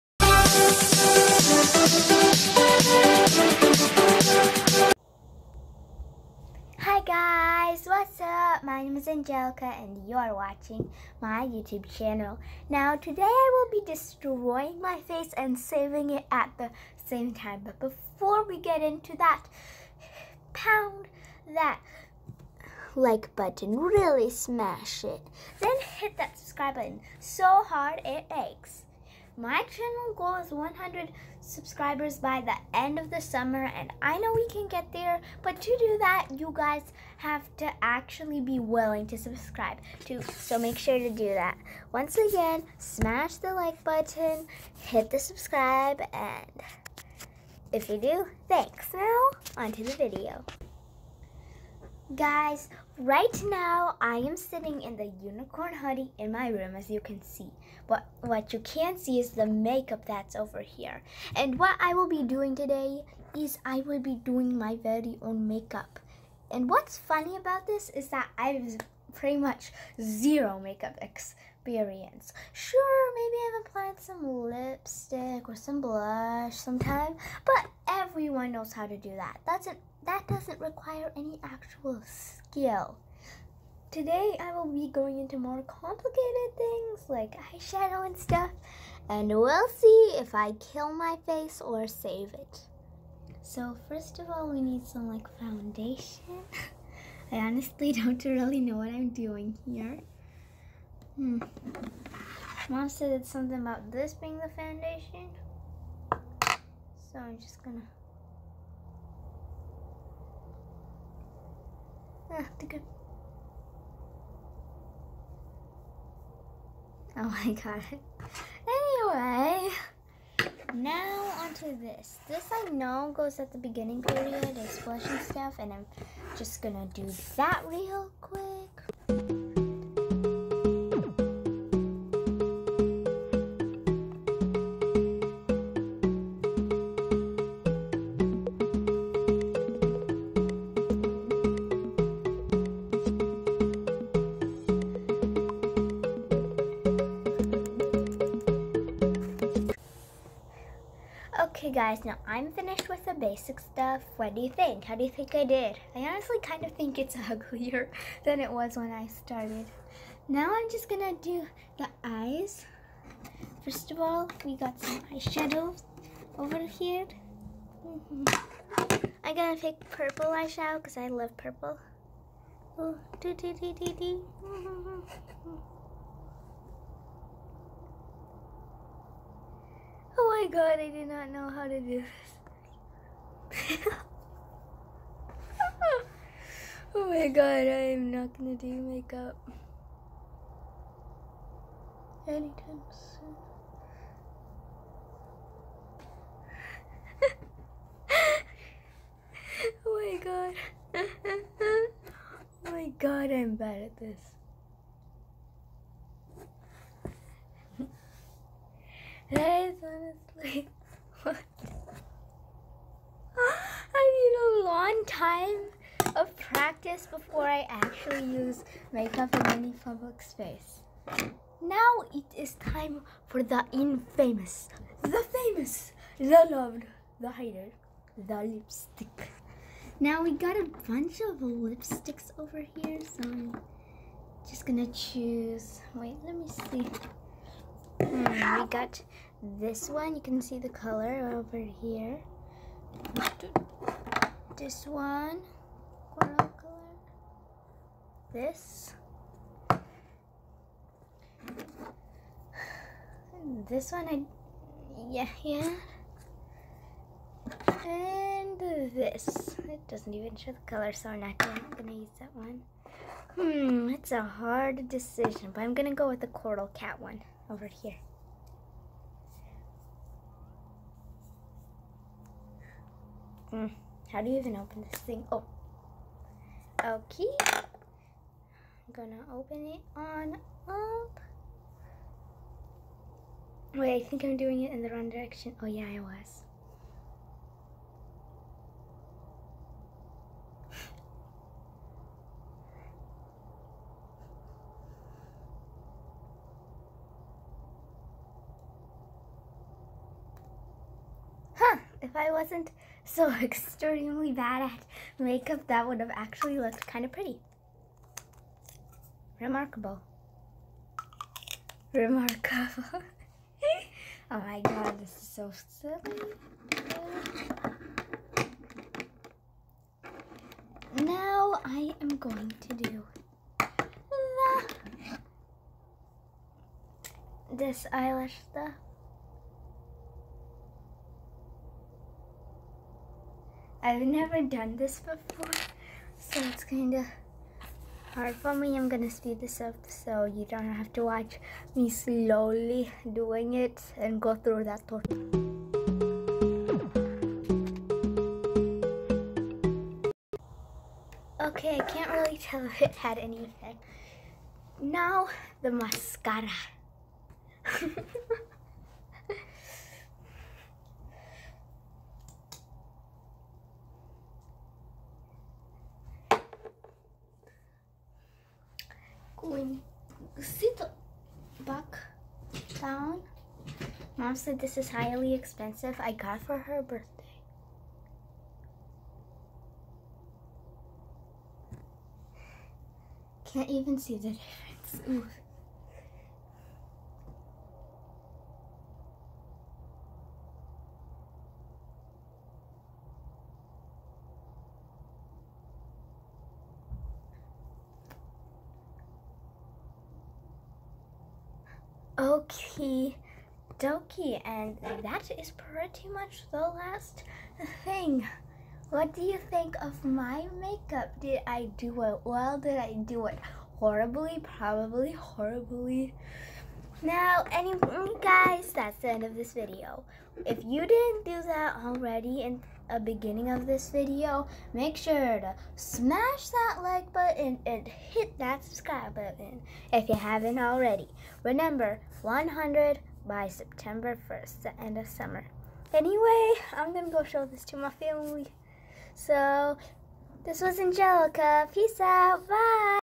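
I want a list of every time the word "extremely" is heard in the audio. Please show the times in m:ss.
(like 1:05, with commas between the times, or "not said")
5:03.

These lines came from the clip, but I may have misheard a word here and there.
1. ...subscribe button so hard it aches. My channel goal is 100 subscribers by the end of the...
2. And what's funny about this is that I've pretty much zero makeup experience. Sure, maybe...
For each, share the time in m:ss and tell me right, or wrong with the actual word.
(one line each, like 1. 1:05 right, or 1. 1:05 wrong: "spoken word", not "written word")
1. 0:26 right
2. 1:06 right.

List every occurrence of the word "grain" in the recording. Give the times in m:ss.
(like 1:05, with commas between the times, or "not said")
not said.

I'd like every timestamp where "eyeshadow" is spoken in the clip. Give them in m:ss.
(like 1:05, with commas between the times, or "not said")
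1:27, 2:45, 2:50.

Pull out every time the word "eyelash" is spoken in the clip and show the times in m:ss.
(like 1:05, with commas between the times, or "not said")
5:27.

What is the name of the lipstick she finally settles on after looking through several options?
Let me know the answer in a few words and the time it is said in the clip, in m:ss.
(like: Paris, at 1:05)
Coral Cat, at 4:26.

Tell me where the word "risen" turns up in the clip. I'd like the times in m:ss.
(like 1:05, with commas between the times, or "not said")
not said.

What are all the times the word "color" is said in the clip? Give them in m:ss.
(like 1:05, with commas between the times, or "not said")
4:00, 4:06, 4:20.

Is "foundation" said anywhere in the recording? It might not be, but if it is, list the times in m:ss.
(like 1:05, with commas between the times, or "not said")
1:35, 1:44.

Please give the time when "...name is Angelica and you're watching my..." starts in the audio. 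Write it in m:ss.
0:08.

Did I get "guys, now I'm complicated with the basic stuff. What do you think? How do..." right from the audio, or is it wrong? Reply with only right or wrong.
wrong.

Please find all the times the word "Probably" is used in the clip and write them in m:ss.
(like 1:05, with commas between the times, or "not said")
6:54.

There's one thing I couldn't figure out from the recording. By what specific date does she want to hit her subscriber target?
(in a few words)
September 1st.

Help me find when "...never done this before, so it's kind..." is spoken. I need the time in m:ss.
5:34.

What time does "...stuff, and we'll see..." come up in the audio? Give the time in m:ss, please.
1:28.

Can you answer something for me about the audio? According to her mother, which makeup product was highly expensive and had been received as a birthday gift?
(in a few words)
mascara.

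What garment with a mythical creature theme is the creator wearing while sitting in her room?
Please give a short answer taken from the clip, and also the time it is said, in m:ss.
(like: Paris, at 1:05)
unicorn hoodie, at 0:55.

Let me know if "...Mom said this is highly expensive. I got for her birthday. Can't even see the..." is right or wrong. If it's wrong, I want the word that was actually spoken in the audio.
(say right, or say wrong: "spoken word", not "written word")
right.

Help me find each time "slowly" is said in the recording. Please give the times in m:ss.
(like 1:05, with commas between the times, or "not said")
5:41.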